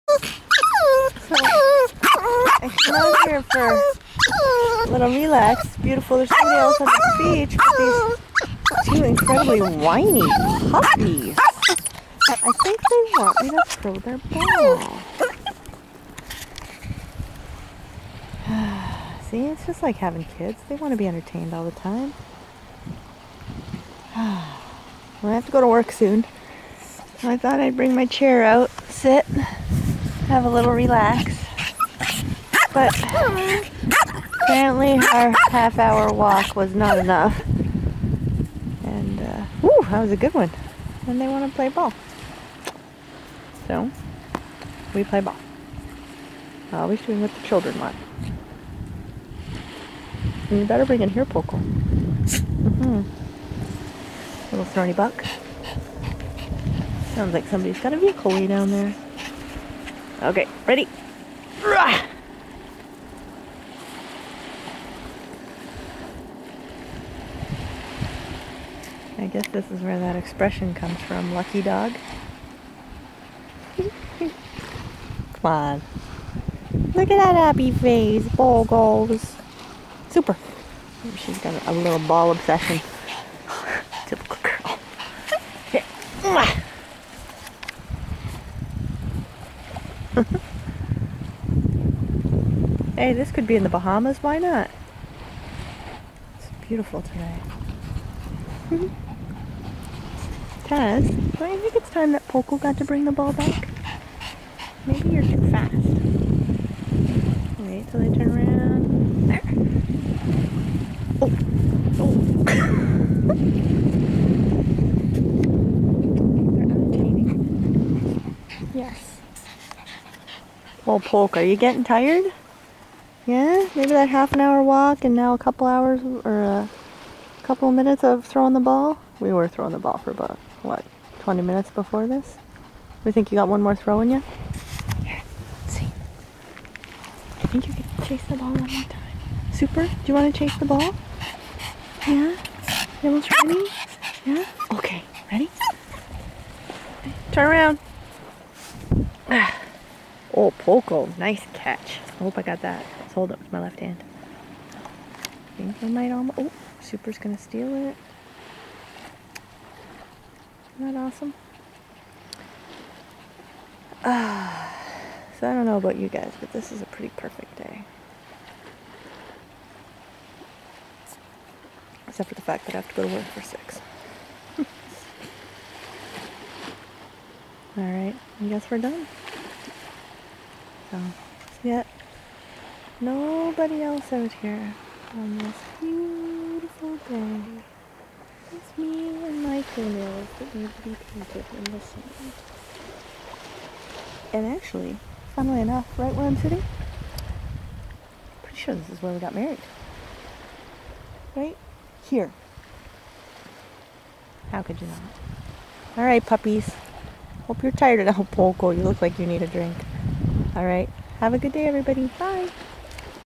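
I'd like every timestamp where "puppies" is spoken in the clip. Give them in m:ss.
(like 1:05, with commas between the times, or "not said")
0:10, 3:26.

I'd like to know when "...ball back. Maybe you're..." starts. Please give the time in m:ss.
1:43.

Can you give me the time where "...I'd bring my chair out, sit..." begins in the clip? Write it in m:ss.
0:27.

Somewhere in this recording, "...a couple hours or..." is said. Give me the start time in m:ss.
2:05.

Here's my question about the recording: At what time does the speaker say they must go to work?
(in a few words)
6.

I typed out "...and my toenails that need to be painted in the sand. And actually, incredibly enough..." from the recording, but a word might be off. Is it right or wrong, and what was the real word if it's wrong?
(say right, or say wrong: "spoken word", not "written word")
wrong: "funnily", not "incredibly".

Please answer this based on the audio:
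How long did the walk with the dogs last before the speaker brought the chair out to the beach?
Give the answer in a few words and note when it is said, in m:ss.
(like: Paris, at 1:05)
half hour, at 0:35.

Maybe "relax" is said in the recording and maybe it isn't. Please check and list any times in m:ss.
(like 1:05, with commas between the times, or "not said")
0:05, 0:30.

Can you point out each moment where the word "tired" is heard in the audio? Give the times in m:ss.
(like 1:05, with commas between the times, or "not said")
2:01, 3:27.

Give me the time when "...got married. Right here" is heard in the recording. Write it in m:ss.
3:19.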